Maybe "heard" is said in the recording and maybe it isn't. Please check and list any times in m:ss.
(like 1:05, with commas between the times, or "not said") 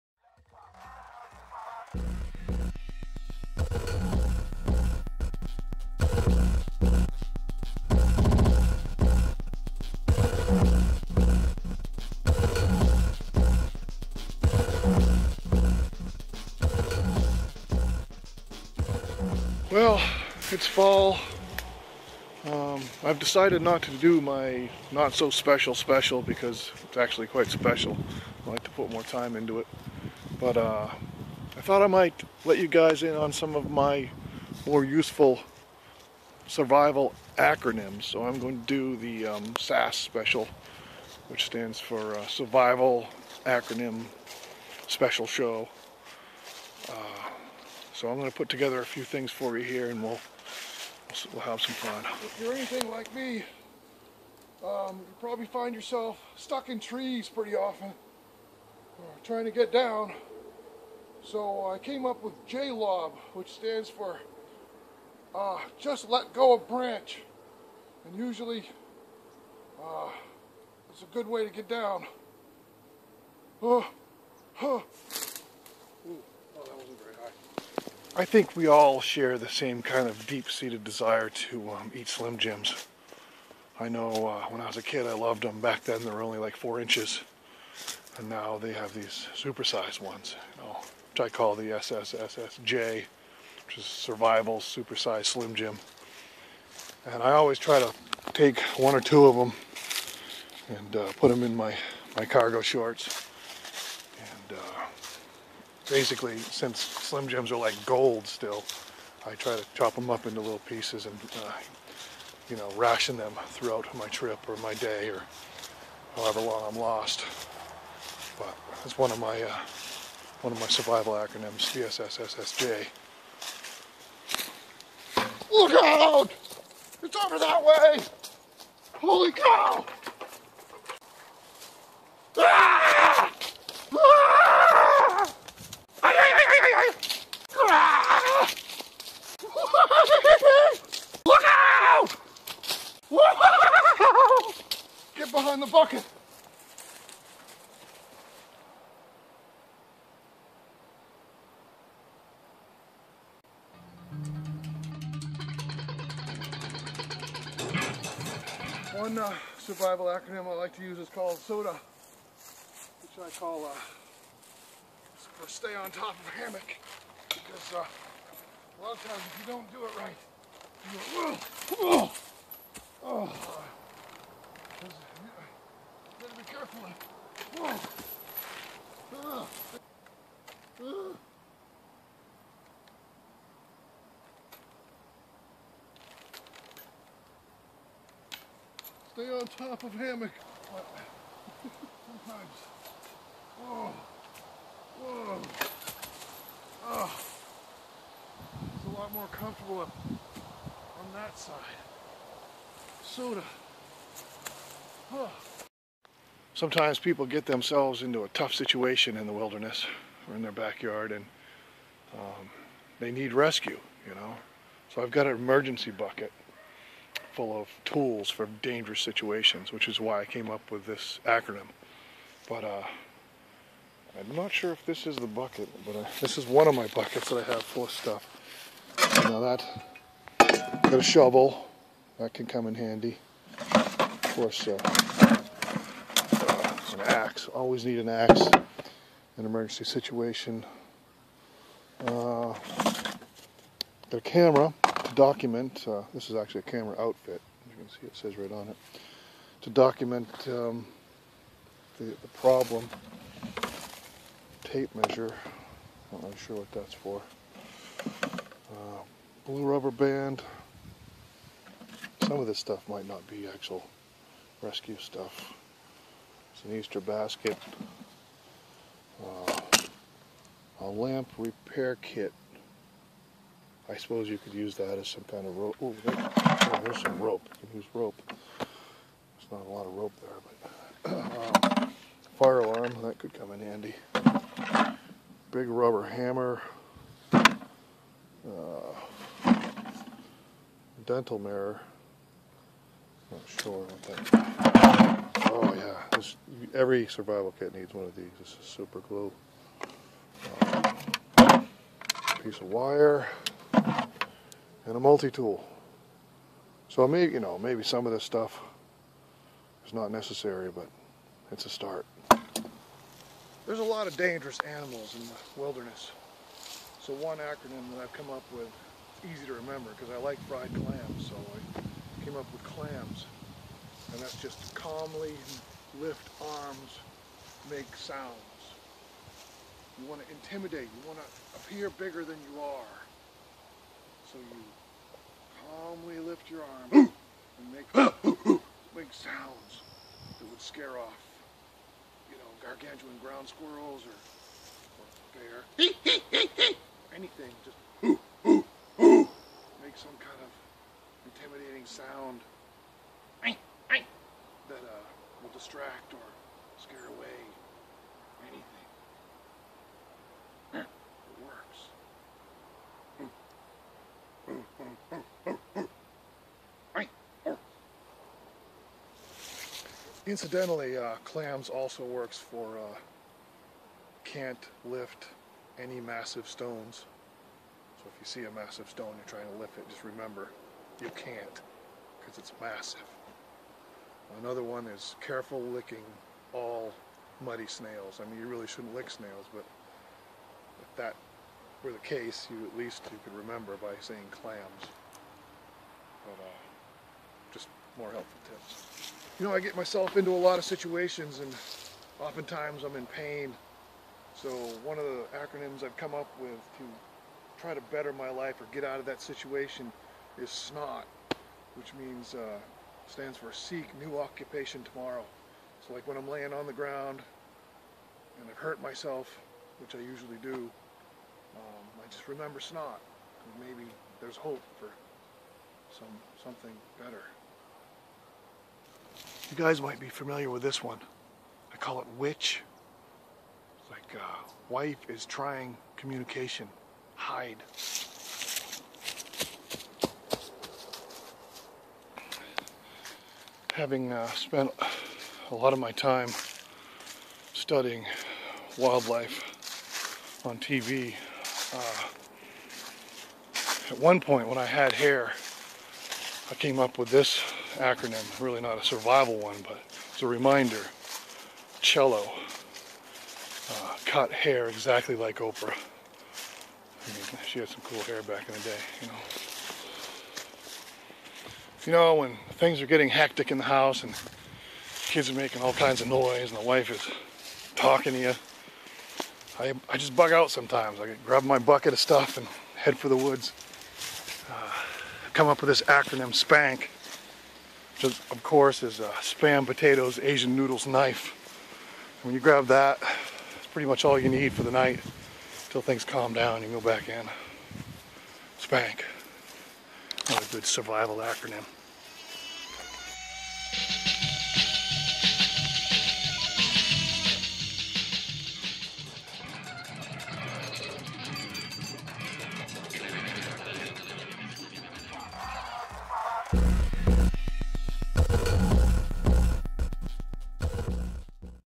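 not said.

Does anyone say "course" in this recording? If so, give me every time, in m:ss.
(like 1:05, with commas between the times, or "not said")
3:54, 8:08.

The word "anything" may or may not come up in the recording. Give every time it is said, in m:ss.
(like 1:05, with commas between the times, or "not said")
0:52, 5:47.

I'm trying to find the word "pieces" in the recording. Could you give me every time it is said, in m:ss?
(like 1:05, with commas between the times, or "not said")
1:50, 5:02.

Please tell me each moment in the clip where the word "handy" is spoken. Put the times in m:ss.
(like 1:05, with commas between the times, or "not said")
3:52, 4:43.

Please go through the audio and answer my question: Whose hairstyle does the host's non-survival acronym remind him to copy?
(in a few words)
Oprah.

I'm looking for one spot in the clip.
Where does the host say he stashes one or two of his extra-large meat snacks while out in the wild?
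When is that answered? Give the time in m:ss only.
1:42.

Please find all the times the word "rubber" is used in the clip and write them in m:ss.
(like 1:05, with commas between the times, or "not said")
4:19, 4:45.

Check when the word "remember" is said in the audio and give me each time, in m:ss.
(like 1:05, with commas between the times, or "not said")
5:19, 6:20, 6:33, 7:02.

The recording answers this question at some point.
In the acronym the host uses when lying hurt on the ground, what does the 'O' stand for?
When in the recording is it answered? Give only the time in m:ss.
6:54.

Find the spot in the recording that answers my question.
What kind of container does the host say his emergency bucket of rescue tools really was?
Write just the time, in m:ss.
4:26.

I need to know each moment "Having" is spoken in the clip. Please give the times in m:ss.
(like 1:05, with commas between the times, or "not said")
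7:23.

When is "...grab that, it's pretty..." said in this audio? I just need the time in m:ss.
8:12.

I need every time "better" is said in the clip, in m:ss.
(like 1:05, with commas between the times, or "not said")
6:47, 7:07.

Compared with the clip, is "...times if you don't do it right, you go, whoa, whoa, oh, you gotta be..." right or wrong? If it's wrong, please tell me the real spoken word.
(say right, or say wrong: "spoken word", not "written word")
right.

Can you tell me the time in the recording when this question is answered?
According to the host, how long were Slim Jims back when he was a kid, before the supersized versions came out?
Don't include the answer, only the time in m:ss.
1:26.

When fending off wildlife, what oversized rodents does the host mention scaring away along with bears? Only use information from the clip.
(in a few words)
gargantuan ground squirrels.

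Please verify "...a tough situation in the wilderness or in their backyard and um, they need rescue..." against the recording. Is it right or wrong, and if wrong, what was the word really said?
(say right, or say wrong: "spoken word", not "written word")
right.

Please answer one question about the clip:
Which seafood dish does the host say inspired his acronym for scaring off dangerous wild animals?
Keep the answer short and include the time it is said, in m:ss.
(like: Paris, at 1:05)
fried clams, at 5:20.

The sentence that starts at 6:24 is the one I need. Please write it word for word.
Another one is careful licking all muddy snails.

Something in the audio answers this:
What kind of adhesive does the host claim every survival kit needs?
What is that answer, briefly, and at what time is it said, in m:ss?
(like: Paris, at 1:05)
super glue, at 4:58.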